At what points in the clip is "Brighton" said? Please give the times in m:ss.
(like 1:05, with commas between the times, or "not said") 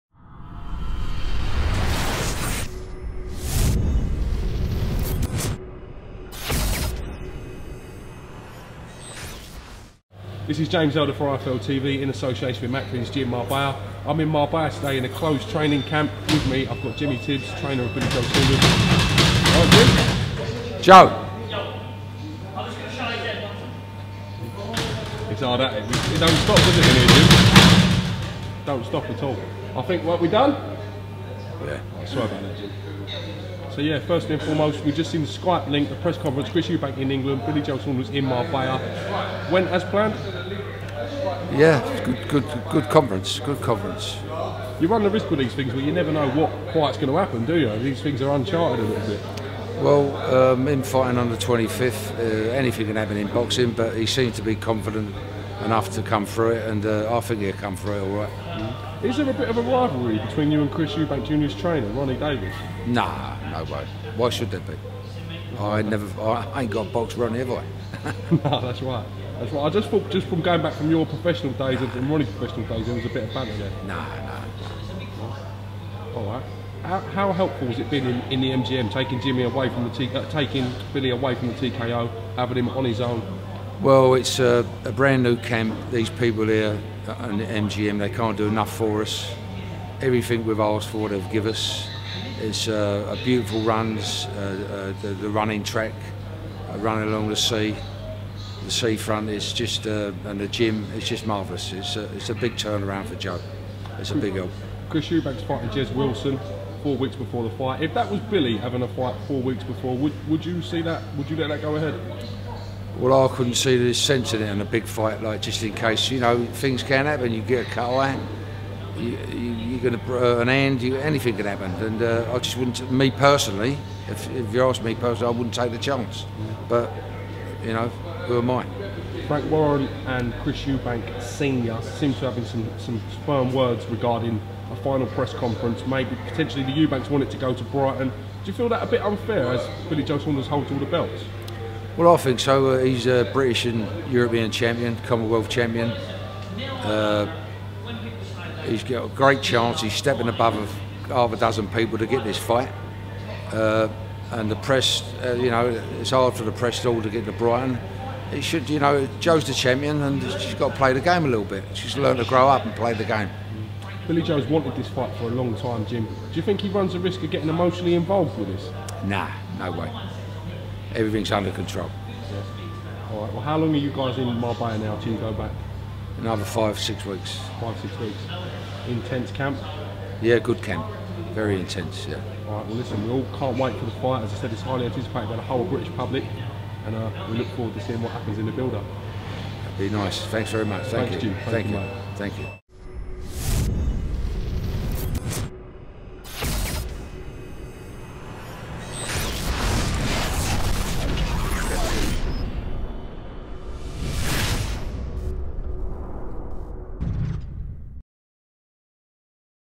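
2:17, 2:37.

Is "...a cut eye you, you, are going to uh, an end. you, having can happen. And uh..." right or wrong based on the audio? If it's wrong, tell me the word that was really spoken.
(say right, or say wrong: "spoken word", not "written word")
wrong: "anything", not "having".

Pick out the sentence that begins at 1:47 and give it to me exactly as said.
If that was Billy having a fight four weeks before, would would you see that?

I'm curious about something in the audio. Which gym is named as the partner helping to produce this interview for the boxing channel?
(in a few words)
Macklins Gym Marbella.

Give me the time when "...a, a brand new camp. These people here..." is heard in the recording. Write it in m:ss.
1:24.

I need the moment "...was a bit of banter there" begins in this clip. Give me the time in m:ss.
1:12.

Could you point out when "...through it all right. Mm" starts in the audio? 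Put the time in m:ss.
0:57.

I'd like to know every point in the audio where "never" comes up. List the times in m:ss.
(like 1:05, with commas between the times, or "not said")
0:45, 1:05.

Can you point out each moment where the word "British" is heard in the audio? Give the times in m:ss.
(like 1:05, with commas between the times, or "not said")
2:23, 3:05.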